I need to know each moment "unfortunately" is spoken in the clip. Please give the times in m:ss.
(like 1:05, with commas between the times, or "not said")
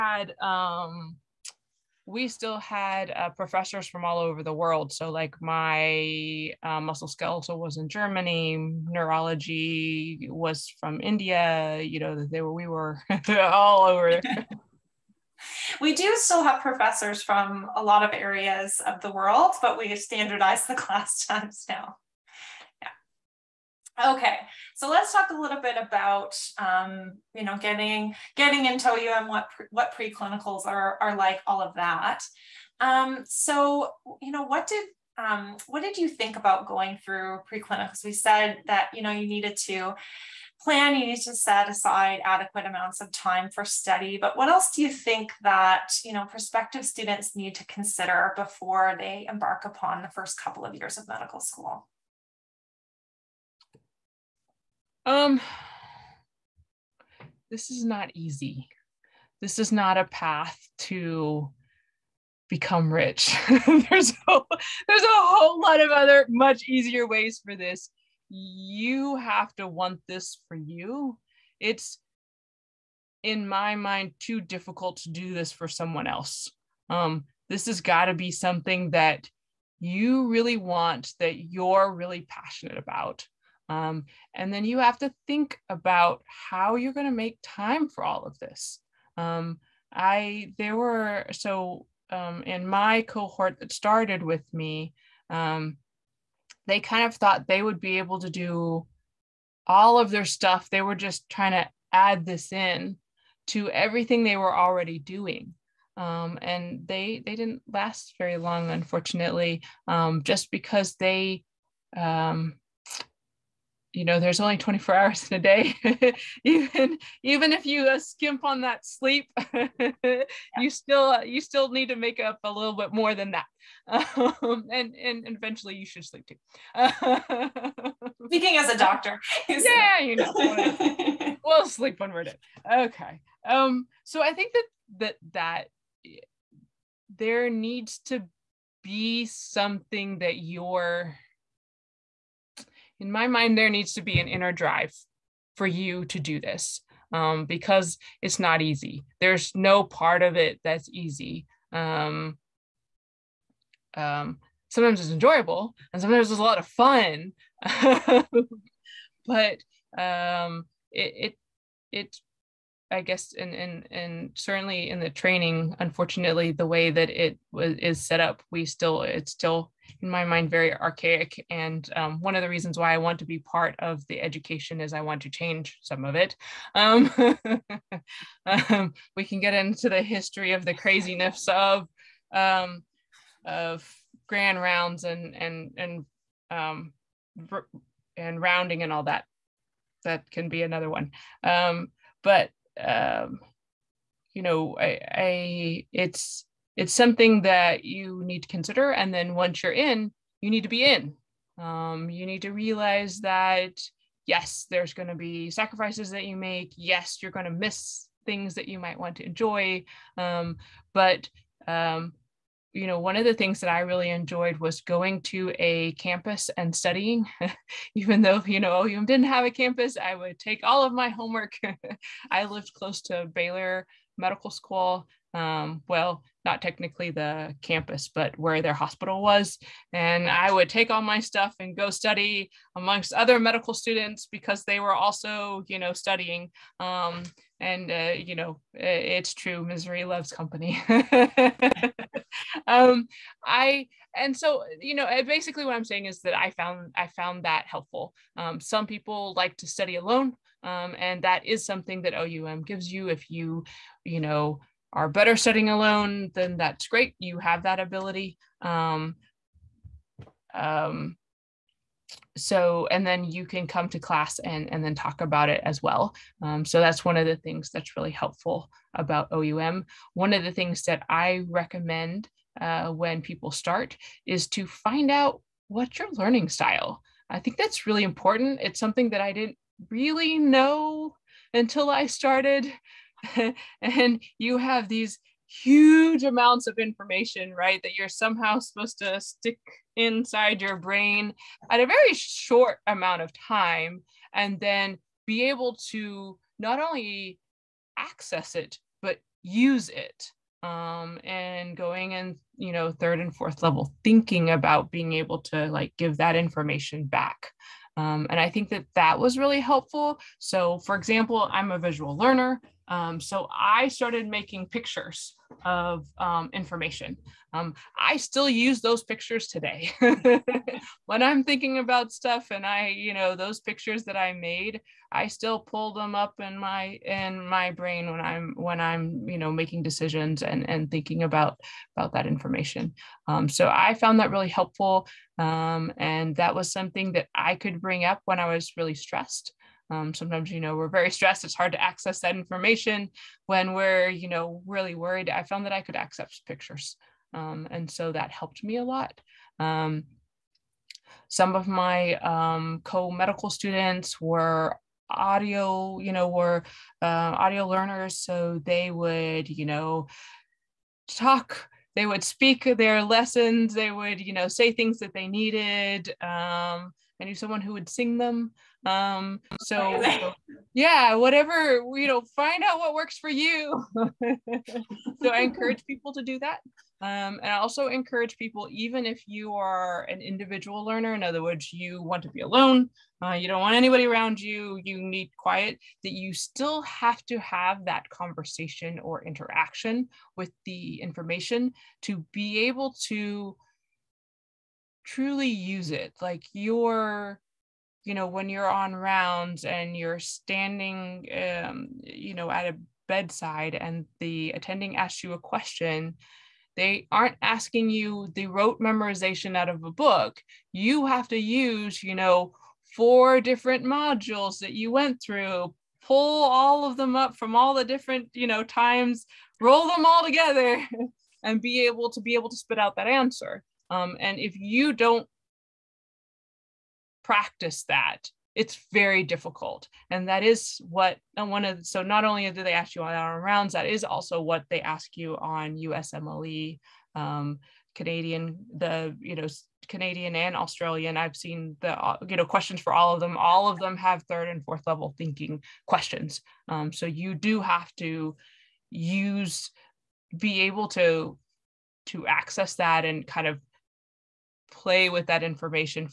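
1:48, 2:45.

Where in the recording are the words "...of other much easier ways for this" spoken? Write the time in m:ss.
1:05.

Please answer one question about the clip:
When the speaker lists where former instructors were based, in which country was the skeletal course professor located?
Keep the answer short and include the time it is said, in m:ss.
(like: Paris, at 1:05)
Germany, at 0:07.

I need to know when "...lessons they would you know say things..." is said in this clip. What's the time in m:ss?
6:03.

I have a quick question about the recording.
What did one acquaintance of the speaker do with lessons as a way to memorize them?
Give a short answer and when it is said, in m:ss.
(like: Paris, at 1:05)
Sing them, at 6:07.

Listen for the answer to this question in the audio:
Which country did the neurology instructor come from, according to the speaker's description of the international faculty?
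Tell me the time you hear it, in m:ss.
0:11.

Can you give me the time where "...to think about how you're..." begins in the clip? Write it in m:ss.
1:24.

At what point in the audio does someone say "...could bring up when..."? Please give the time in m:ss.
5:37.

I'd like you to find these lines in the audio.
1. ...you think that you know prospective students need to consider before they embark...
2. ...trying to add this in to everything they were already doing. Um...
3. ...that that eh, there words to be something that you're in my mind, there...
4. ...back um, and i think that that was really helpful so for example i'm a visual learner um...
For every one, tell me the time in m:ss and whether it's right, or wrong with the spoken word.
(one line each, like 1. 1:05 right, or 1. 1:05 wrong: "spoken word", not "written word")
1. 0:44 right
2. 1:41 right
3. 2:14 wrong: "needs", not "words"
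4. 5:07 right.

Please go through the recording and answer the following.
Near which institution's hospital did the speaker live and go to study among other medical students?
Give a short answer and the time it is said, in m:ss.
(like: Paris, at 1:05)
Baylor Medical School, at 3:43.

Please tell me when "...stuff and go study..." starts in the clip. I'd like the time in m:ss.
3:51.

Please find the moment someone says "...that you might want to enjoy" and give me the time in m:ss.
3:28.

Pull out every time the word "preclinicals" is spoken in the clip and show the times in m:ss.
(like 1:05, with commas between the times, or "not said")
0:29, 0:37.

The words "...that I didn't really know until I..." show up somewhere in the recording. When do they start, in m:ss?
4:39.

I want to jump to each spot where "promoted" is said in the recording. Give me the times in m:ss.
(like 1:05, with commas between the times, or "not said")
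not said.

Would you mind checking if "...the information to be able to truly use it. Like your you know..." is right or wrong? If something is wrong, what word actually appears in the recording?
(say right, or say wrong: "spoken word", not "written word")
right.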